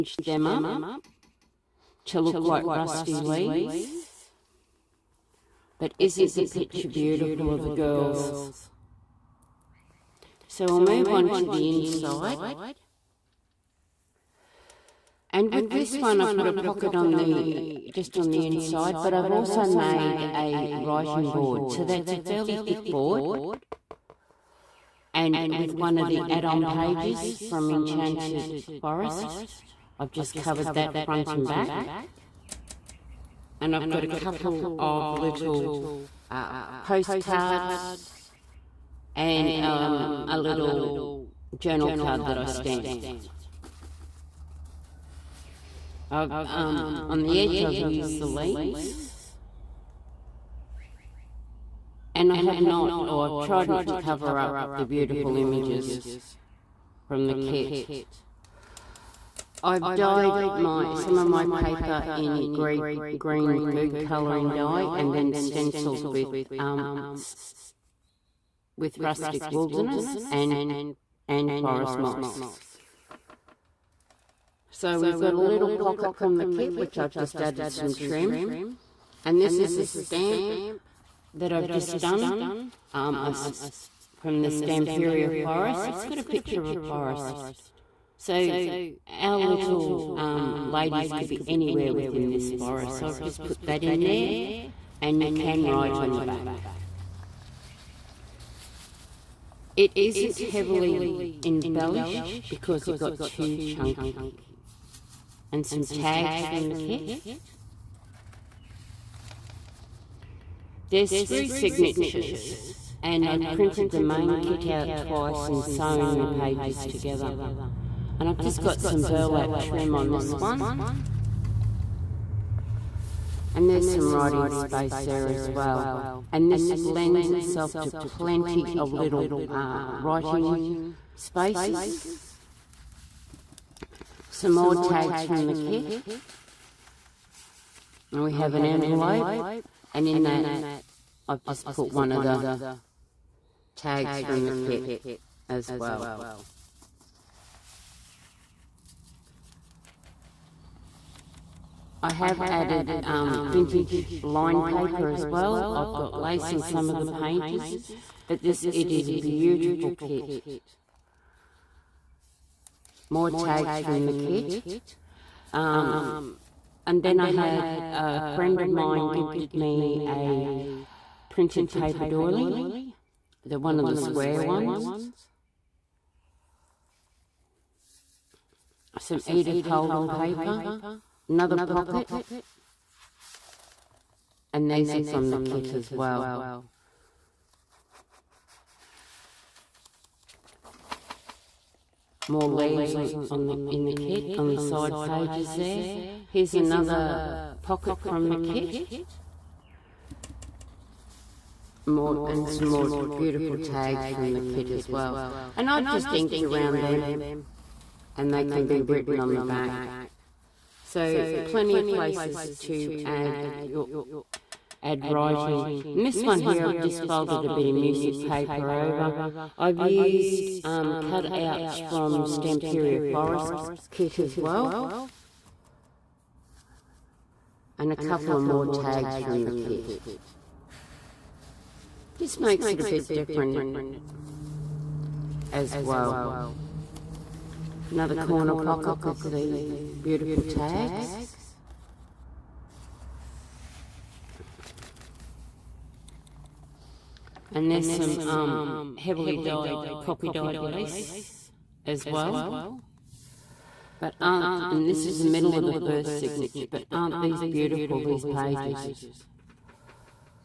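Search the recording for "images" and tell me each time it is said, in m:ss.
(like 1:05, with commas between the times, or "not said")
0:55.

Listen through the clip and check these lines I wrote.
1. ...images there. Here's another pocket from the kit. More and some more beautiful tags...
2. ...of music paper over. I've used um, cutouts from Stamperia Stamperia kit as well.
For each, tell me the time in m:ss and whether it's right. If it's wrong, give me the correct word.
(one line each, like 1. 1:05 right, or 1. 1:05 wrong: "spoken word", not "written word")
1. 3:14 wrong: "pages", not "images"
2. 3:37 wrong: "Forest", not "Stamperia".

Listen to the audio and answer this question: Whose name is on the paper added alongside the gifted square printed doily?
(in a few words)
Edith Holden.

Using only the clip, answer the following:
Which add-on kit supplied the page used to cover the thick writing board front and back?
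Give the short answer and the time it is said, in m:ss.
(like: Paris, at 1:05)
Enchanted Forest, at 0:27.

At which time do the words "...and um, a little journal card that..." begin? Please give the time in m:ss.
0:39.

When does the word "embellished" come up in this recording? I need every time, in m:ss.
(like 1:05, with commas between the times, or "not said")
1:41.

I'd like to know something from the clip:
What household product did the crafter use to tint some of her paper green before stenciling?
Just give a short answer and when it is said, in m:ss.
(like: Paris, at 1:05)
green food colouring, at 1:03.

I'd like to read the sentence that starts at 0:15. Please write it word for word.
And with this one, I put a pocket on the just on the inside, but I've also made a writing board.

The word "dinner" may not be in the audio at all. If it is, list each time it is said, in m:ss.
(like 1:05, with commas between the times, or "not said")
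not said.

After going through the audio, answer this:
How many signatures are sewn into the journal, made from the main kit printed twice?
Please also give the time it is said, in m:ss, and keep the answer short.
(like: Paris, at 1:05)
3, at 1:51.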